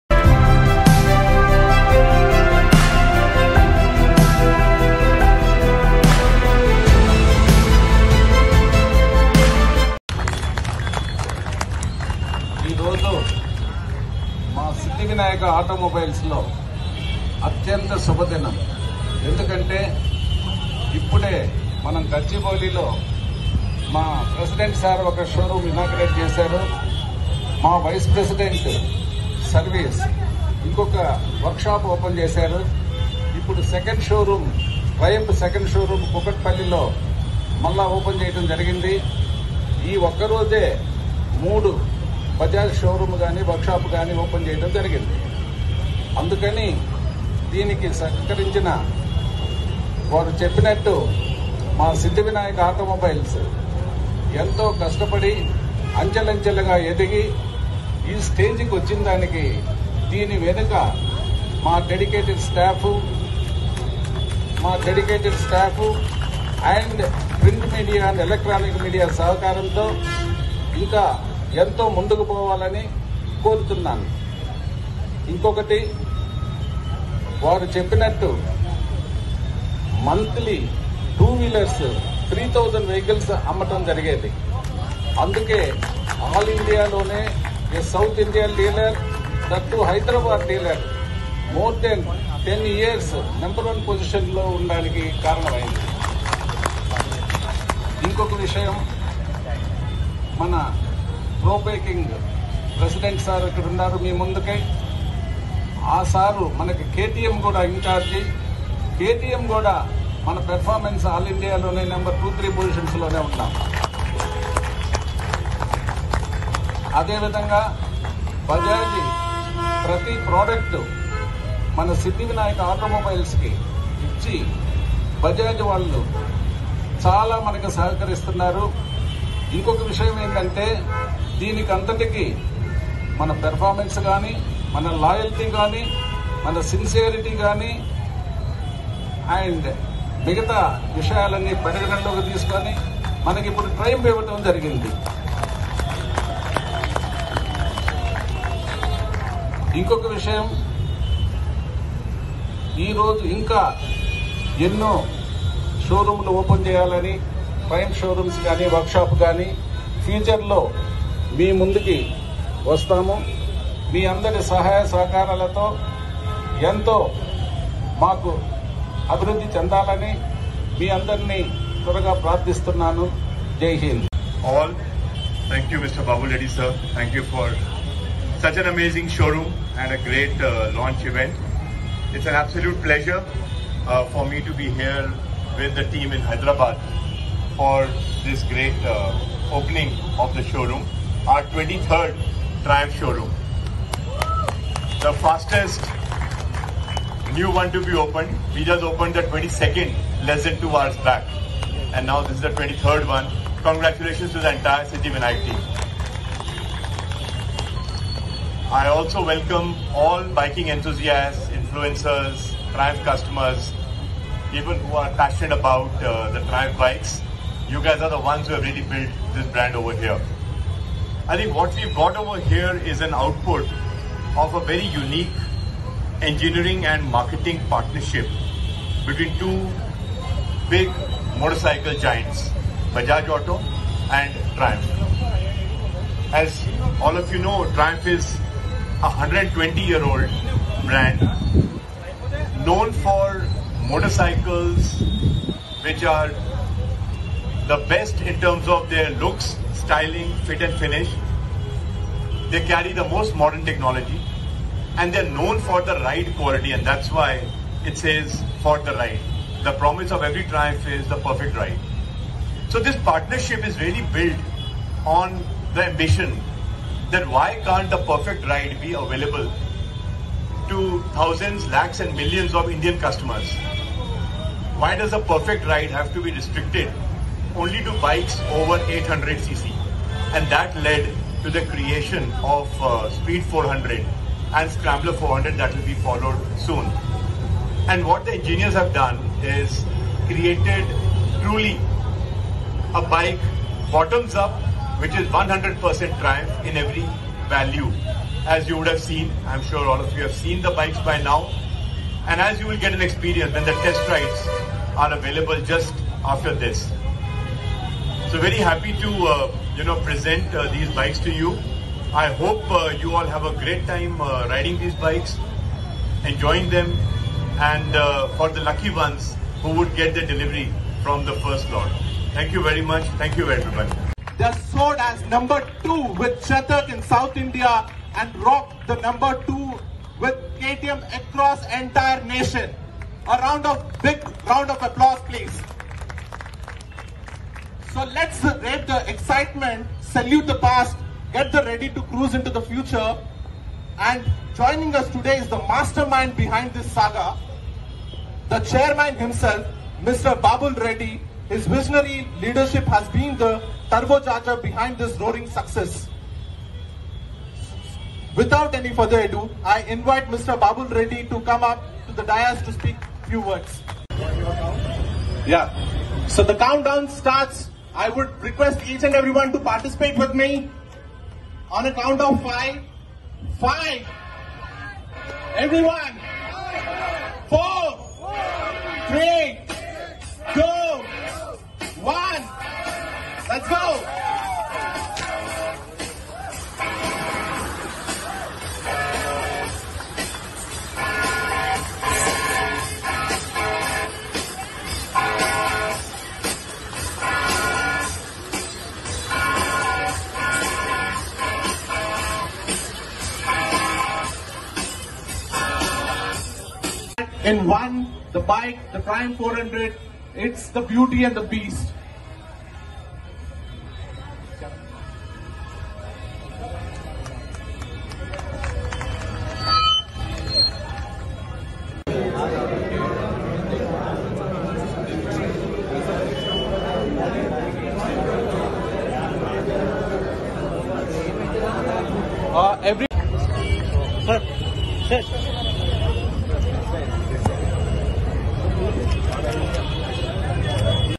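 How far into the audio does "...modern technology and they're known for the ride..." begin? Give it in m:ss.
4:13.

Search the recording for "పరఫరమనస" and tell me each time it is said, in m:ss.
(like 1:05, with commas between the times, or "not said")
1:50, 2:13.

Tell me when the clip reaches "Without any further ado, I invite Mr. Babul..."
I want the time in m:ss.
5:58.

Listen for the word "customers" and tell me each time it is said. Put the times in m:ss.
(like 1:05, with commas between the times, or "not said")
3:33, 4:32.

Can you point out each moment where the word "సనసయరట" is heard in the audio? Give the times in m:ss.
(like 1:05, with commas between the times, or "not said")
2:16.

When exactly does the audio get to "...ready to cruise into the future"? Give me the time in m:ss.
5:41.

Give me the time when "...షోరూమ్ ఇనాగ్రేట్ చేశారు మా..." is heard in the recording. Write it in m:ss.
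0:25.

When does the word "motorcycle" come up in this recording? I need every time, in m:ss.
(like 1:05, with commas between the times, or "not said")
3:51, 4:03.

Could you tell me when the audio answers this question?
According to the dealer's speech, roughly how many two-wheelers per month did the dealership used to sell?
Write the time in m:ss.
1:22.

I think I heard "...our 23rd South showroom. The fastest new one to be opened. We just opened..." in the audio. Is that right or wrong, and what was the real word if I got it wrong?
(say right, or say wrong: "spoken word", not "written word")
wrong: "Triumph", not "South".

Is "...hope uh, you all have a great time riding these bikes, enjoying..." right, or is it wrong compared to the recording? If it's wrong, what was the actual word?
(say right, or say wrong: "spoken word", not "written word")
right.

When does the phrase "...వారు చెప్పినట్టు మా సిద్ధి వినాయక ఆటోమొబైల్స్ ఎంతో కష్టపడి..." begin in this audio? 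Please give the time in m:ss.
0:50.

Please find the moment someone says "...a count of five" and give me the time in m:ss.
6:11.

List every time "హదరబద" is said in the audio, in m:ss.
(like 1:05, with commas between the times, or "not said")
1:29, 3:06.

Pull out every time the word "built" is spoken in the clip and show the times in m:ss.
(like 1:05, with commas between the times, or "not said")
3:38, 4:24.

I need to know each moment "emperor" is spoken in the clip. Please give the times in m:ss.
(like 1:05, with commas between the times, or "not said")
not said.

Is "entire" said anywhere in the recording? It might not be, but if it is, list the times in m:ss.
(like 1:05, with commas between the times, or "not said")
3:24, 5:31.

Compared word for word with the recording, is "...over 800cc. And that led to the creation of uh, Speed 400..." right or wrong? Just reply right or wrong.
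right.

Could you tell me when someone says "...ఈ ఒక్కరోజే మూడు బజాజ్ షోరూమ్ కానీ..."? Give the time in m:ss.
0:39.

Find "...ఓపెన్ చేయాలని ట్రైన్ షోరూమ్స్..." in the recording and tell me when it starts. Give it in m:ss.
2:36.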